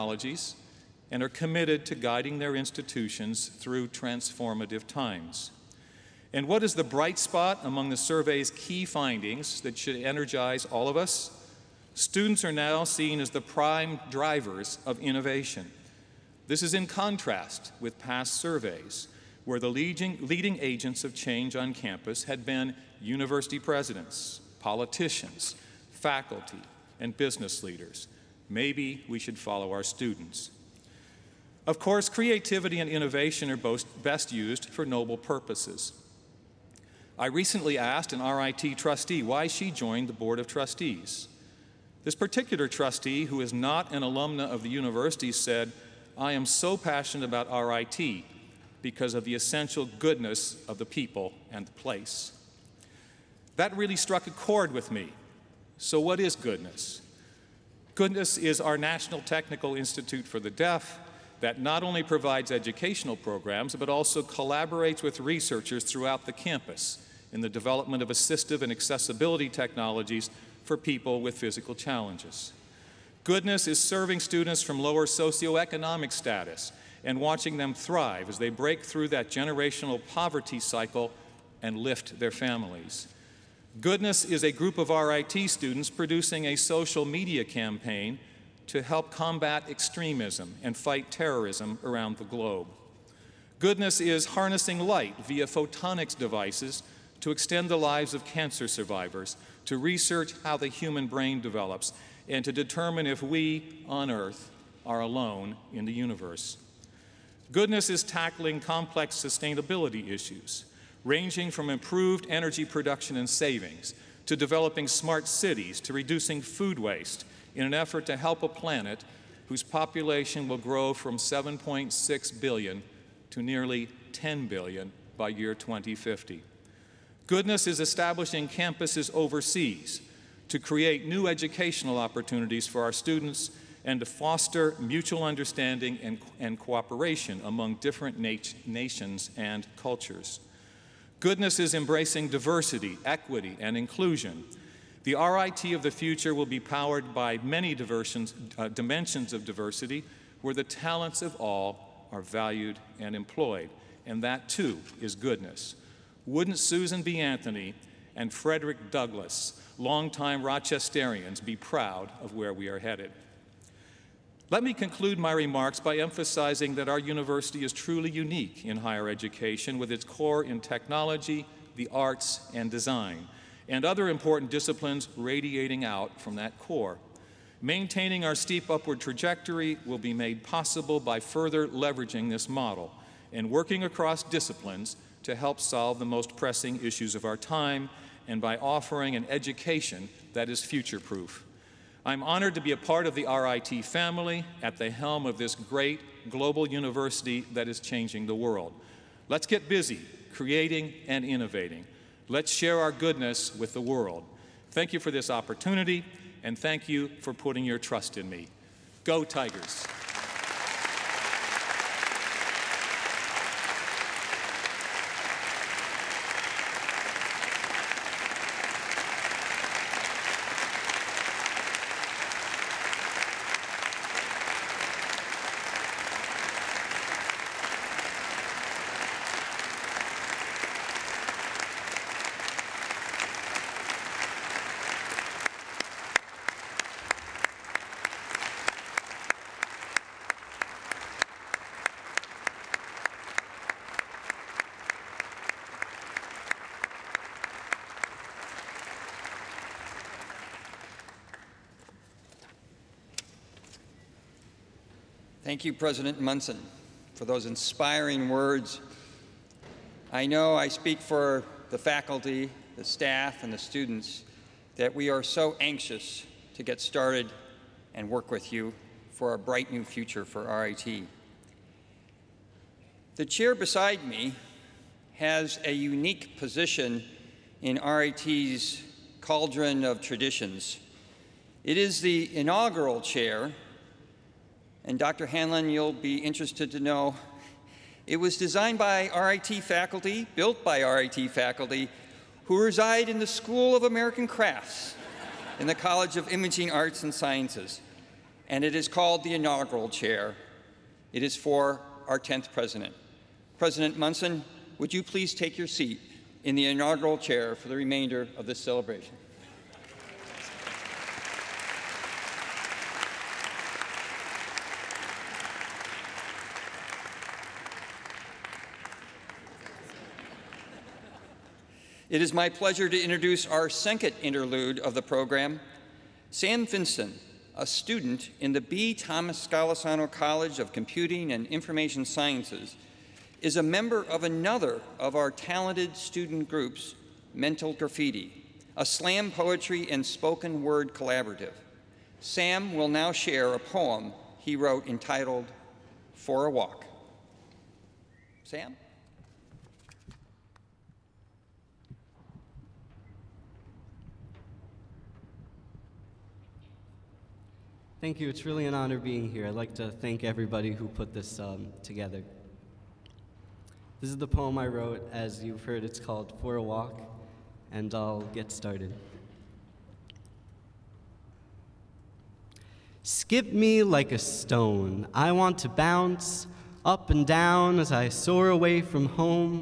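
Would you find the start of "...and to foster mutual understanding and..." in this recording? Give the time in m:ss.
2:13.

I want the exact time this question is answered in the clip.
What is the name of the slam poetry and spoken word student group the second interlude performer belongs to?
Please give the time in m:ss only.
5:37.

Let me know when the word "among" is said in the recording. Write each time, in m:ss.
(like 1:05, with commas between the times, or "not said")
0:07, 2:17.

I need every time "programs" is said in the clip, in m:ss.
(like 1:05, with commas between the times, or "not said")
1:03, 5:25.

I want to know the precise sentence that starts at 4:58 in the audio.
And it is called the inaugural chair.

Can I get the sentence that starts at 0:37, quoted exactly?
I recently asked an RIT trustee why she joined the Board of Trustees.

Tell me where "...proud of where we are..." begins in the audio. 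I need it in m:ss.
2:41.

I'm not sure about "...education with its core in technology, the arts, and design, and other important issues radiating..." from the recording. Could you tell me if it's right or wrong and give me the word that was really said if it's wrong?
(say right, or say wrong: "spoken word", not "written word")
wrong: "disciplines", not "issues".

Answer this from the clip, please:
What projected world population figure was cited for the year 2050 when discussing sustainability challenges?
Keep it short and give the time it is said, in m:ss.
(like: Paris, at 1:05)
nearly 10 billion, at 2:03.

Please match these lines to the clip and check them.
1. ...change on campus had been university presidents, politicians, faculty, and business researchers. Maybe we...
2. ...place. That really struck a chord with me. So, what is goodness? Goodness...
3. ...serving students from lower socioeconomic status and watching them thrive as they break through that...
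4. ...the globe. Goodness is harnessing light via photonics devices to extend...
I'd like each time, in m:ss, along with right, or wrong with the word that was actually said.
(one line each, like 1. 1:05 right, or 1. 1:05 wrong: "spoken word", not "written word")
1. 0:21 wrong: "leaders", not "researchers"
2. 0:51 right
3. 1:13 right
4. 1:32 right.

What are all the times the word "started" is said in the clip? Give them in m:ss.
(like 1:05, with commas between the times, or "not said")
4:26, 6:08.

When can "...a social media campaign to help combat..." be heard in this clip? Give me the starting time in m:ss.
1:26.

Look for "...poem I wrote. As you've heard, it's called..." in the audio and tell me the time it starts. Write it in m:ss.
6:04.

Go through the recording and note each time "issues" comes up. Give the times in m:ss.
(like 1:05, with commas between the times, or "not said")
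1:50, 3:06.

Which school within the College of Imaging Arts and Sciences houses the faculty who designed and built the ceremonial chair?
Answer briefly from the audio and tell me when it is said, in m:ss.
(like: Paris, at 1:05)
School of American Crafts, at 4:53.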